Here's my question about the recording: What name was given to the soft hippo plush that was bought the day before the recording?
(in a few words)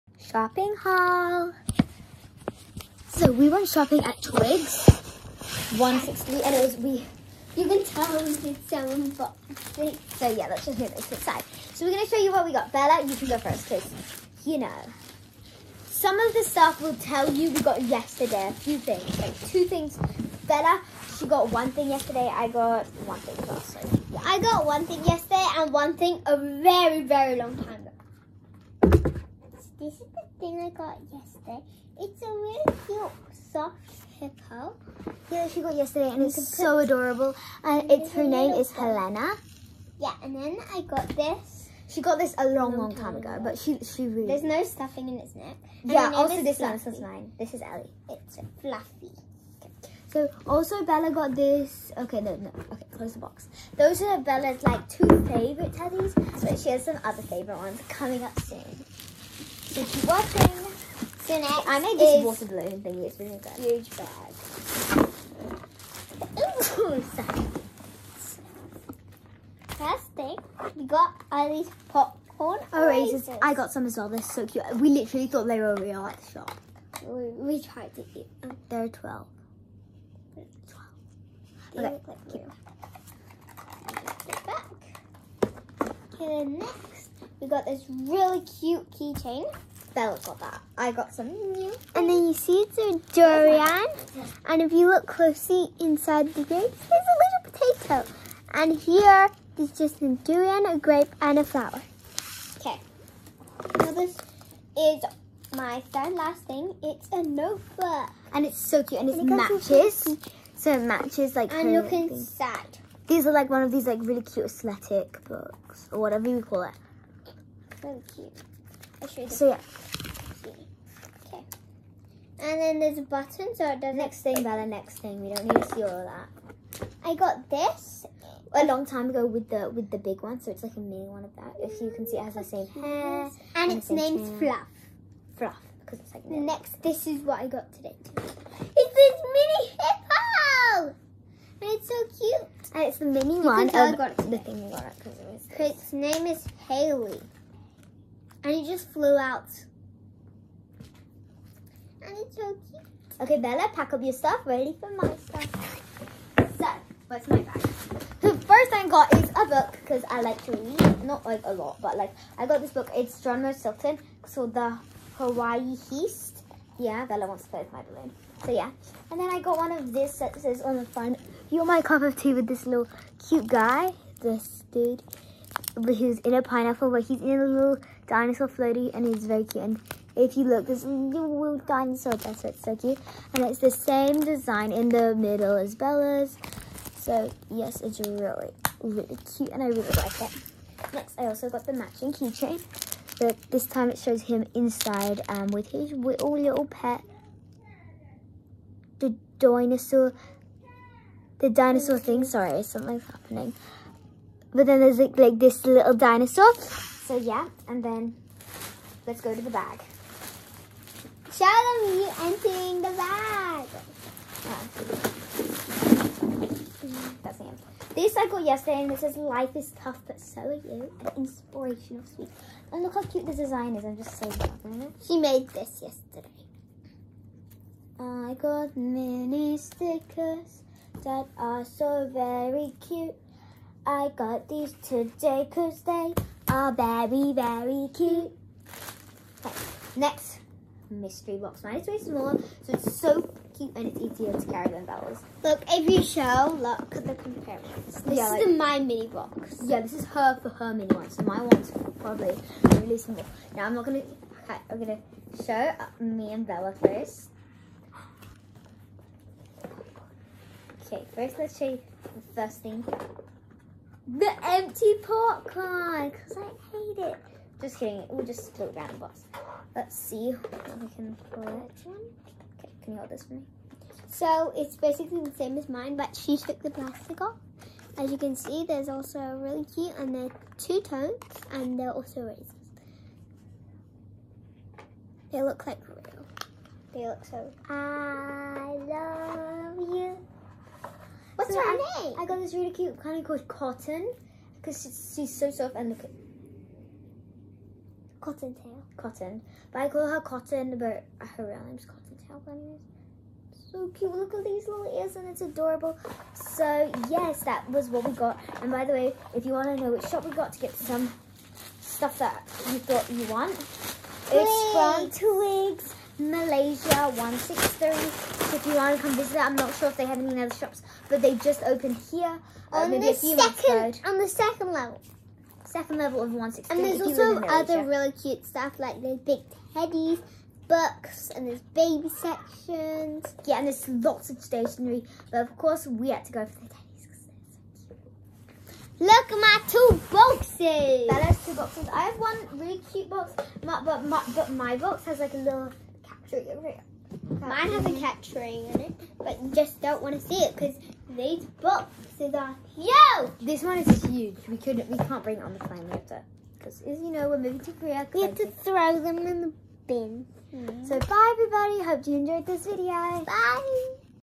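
Helena.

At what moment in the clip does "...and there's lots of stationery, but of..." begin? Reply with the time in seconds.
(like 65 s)
333 s.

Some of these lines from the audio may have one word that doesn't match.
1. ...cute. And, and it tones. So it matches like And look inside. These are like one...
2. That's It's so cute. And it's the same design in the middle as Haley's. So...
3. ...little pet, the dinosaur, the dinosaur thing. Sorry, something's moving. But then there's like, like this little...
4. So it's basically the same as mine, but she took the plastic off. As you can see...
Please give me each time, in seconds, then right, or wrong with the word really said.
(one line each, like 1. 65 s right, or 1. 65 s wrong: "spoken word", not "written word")
1. 108 s wrong: "matches", not "tones"
2. 182 s wrong: "Bella", not "Haley"
3. 196 s wrong: "happening", not "moving"
4. 274 s right.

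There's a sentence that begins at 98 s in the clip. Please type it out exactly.
And here is just a durian, a grape, and a flower.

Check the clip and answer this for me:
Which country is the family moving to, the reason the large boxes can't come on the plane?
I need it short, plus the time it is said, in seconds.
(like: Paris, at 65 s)
Korea, at 357 s.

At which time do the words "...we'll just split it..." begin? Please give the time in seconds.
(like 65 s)
268 s.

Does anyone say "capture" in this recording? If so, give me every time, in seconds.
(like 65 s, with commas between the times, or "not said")
346 s.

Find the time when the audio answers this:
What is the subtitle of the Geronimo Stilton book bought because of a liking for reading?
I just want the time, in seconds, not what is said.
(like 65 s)
164 s.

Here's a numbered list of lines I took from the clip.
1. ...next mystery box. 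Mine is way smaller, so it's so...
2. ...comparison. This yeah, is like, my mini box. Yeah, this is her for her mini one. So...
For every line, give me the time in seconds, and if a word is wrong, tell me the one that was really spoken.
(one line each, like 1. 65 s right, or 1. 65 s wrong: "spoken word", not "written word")
1. 239 s right
2. 247 s right.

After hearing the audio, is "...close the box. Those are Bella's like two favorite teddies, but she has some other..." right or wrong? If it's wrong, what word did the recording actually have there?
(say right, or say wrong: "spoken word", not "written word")
right.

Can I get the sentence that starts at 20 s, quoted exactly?
Bella, she got one thing yesterday, I got one thing also.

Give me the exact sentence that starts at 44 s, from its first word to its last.
There's no stuffing in its neck.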